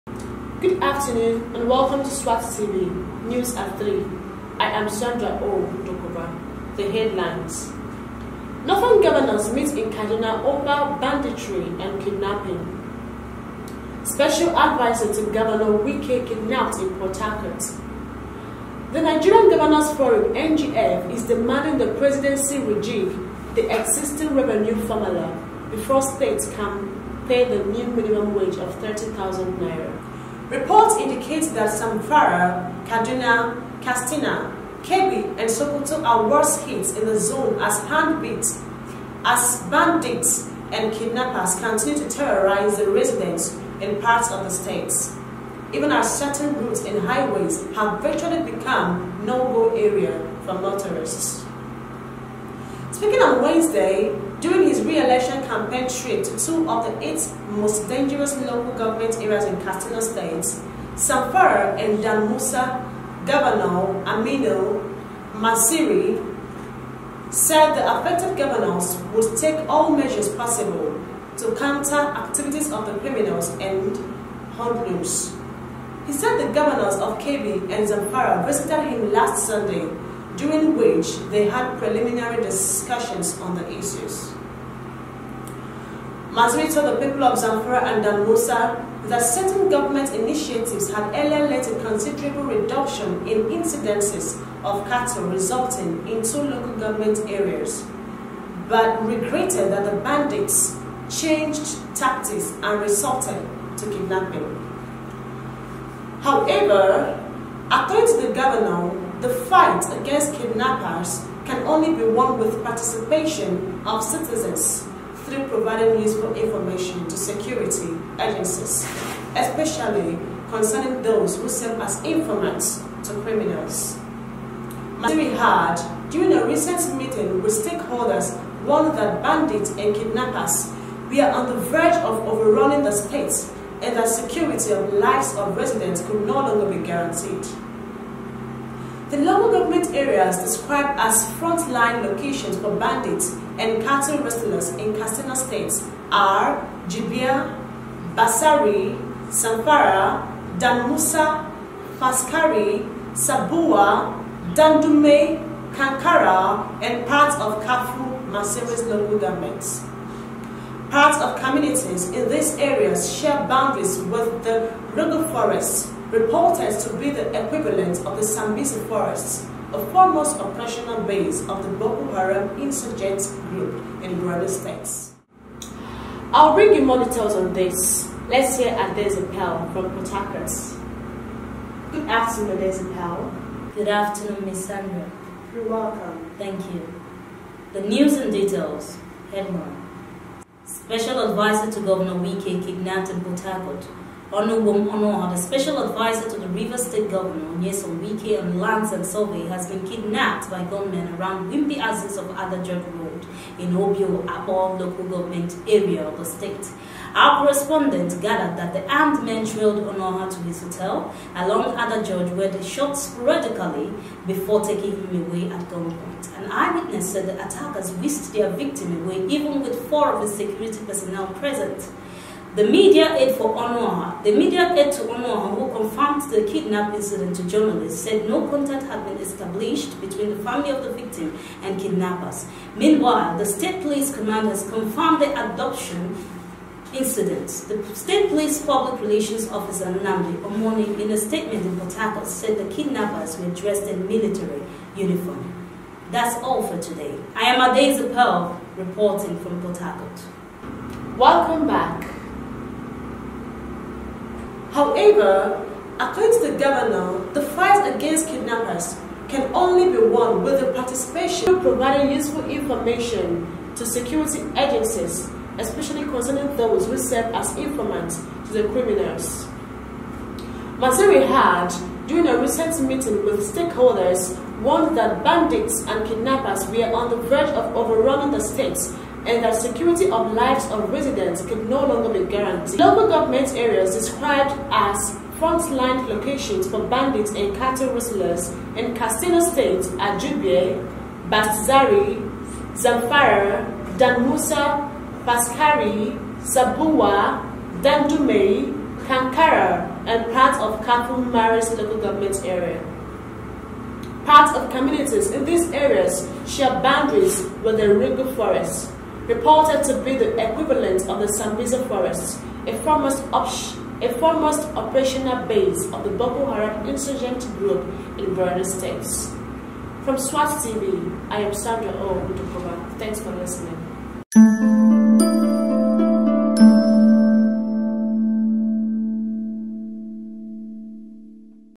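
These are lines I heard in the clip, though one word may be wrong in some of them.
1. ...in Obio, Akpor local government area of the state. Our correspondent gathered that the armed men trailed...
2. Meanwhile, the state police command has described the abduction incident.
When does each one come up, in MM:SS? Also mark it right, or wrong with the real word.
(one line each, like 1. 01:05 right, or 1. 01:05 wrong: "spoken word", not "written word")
1. 03:23 right
2. 03:52 wrong: "confirmed", not "described".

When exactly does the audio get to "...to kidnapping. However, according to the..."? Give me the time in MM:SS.
01:43.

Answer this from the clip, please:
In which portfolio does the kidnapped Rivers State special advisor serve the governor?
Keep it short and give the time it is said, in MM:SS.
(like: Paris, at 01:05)
Lands and survey, at 03:18.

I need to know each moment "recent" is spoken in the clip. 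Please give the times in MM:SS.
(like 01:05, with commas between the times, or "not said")
02:06, 04:32.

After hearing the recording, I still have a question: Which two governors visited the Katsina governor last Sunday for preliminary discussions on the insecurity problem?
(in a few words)
Kebbi and Zamfara.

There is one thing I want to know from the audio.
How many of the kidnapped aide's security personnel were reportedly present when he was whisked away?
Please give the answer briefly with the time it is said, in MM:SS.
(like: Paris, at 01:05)
4, at 03:39.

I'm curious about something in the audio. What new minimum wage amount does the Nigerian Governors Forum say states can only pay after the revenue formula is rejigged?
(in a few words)
30,000 naira.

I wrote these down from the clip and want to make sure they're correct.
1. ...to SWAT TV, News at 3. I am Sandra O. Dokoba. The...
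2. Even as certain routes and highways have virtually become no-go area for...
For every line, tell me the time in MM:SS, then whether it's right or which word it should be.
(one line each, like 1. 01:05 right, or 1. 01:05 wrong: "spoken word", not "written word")
1. 00:02 right
2. 00:45 right.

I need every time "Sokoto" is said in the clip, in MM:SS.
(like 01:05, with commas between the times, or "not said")
00:35.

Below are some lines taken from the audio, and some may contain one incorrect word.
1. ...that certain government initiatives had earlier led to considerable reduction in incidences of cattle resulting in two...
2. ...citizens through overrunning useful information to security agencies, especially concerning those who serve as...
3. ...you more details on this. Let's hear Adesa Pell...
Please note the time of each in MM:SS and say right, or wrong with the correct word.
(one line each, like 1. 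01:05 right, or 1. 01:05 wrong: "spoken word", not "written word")
1. 01:29 right
2. 01:54 wrong: "providing", not "overrunning"
3. 02:56 right.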